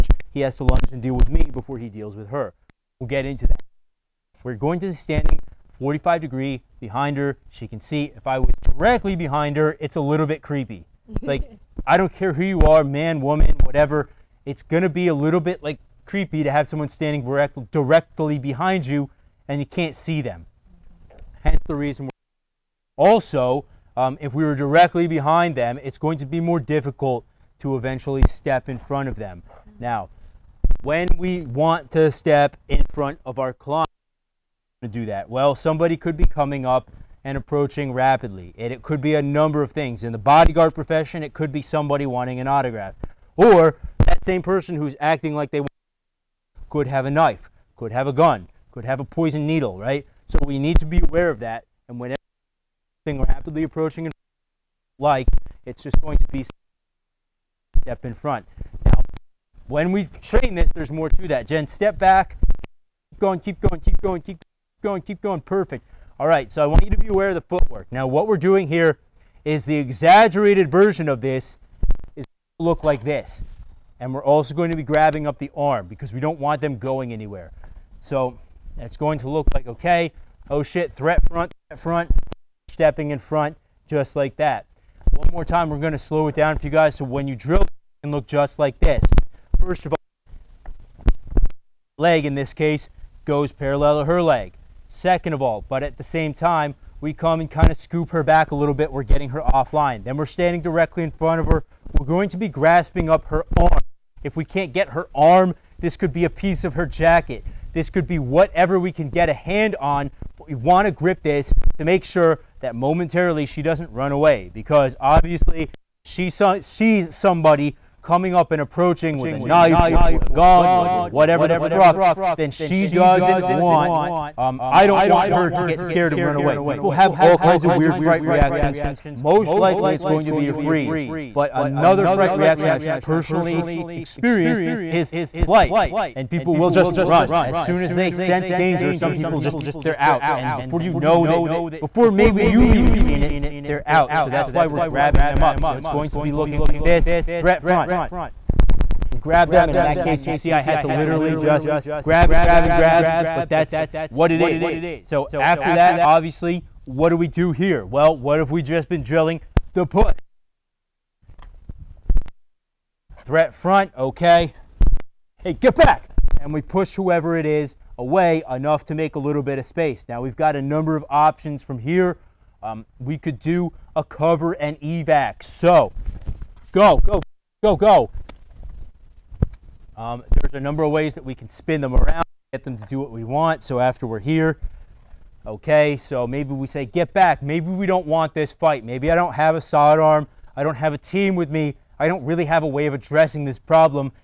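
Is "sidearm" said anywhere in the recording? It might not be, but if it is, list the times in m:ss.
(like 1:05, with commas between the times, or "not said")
3:09.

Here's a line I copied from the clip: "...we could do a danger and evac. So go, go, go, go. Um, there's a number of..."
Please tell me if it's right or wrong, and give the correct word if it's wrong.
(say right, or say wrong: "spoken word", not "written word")
wrong: "cover", not "danger".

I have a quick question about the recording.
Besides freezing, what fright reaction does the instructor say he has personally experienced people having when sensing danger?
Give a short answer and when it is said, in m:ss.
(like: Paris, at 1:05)
Flight, at 2:15.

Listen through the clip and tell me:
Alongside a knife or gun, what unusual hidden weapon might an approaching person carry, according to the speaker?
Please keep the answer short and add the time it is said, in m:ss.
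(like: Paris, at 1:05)
Poison needle, at 0:49.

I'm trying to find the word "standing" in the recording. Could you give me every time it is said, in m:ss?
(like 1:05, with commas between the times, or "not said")
0:04, 0:16, 1:40.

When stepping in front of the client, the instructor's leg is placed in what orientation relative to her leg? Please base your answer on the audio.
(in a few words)
Parallel.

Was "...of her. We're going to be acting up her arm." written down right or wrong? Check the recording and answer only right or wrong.
wrong.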